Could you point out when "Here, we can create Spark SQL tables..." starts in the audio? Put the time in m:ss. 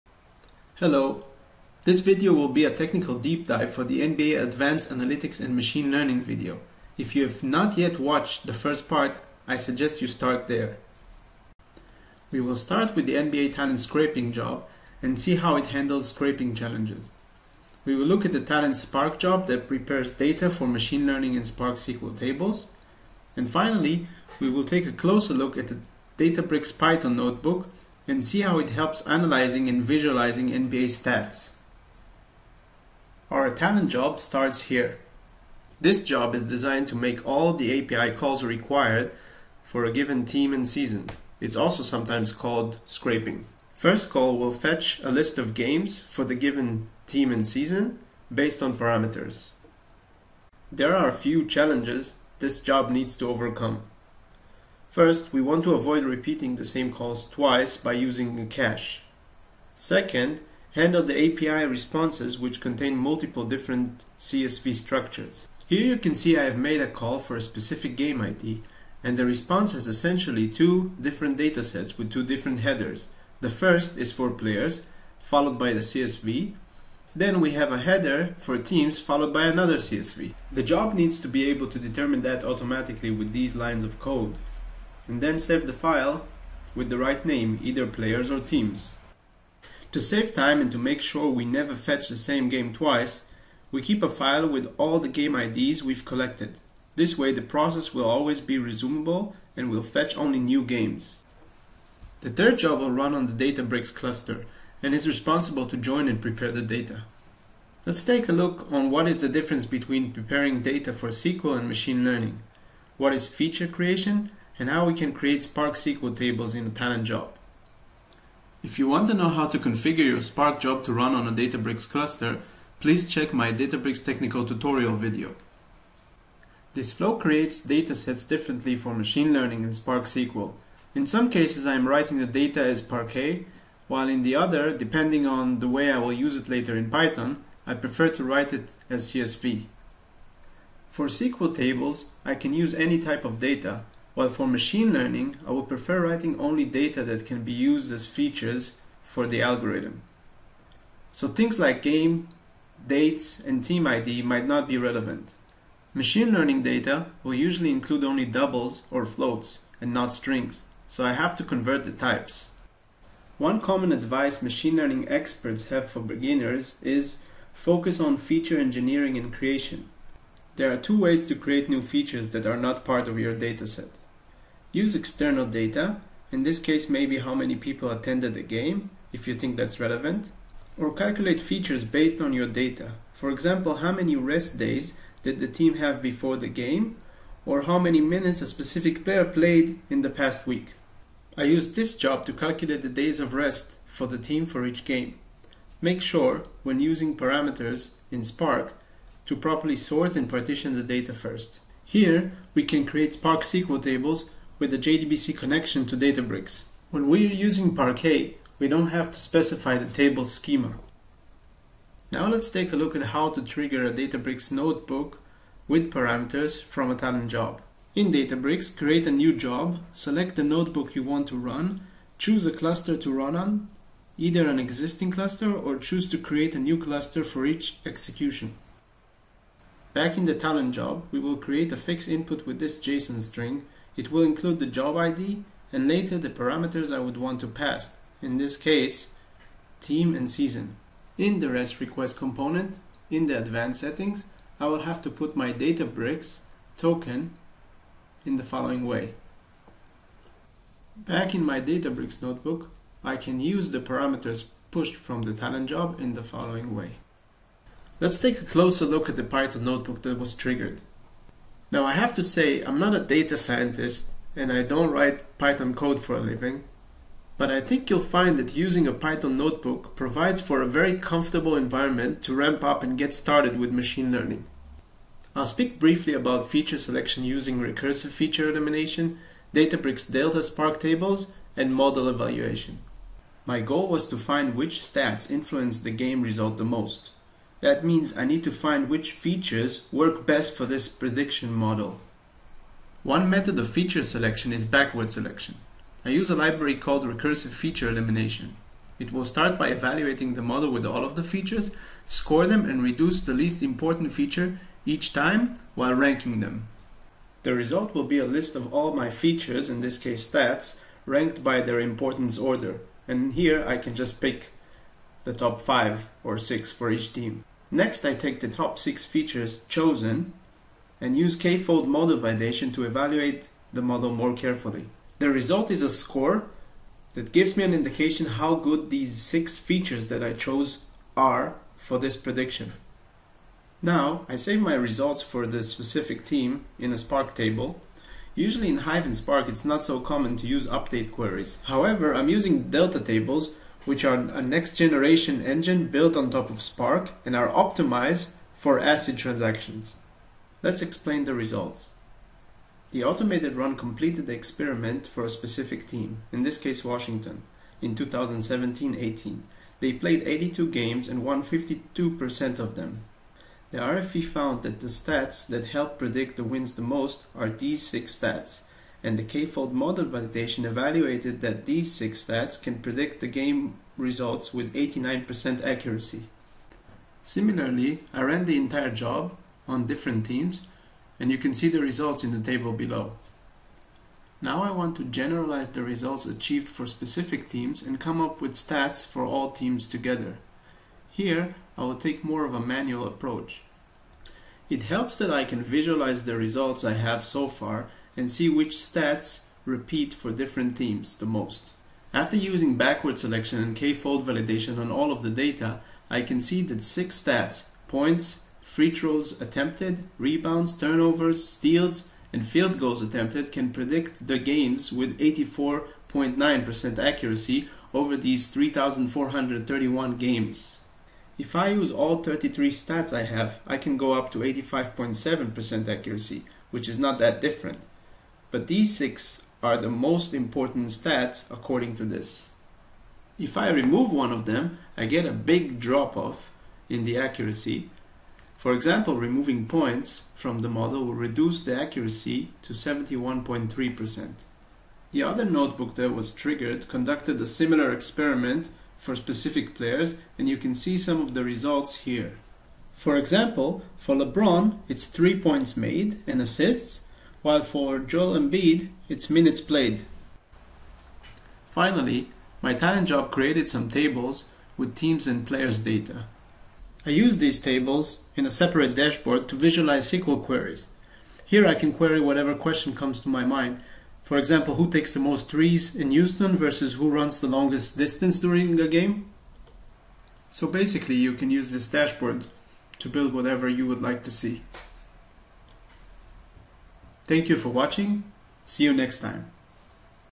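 3:21.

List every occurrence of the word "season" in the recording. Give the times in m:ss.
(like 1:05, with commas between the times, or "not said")
0:40, 0:47, 4:00.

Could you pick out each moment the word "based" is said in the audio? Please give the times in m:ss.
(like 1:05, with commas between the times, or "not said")
0:48, 3:01.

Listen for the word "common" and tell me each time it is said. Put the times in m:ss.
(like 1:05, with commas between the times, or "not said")
2:43, 5:40.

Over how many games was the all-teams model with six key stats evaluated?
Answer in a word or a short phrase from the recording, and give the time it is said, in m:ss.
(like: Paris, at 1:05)
3,431, at 6:58.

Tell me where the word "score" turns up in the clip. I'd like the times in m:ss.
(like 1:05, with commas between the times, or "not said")
5:02, 5:25.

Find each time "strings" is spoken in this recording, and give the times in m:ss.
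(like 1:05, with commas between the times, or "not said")
2:40, 3:53.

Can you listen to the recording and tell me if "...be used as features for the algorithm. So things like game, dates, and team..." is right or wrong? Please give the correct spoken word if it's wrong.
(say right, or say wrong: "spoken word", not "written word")
right.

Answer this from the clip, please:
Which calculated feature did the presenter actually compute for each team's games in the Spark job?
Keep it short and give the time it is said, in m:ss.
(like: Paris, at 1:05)
days of rest, at 3:12.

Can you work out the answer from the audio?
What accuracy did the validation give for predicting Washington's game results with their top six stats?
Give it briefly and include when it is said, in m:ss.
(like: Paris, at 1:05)
89%, at 6:14.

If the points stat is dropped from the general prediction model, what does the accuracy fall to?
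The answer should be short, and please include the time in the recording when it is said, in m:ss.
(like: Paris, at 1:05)
71.3%, at 7:22.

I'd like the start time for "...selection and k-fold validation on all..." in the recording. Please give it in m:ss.
6:43.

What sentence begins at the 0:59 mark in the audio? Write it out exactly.
Second, handle the API responses which contain multiple different CSV structures.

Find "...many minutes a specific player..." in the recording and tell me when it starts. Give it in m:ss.
3:07.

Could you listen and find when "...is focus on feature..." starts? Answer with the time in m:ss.
2:46.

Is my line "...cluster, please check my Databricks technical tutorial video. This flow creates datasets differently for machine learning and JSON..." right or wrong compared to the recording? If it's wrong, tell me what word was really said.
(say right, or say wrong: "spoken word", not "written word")
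wrong: "Spark", not "JSON".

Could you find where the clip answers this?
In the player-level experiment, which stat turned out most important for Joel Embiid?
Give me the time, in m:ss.
7:39.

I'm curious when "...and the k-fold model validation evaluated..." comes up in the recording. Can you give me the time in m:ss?
6:09.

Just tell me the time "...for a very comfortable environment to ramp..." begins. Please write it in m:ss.
4:30.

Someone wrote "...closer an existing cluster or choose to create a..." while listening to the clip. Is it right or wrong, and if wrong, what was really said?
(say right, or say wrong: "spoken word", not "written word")
wrong: "either", not "closer".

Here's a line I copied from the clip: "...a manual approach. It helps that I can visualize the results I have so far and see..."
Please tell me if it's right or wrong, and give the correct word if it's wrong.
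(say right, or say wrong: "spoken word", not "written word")
right.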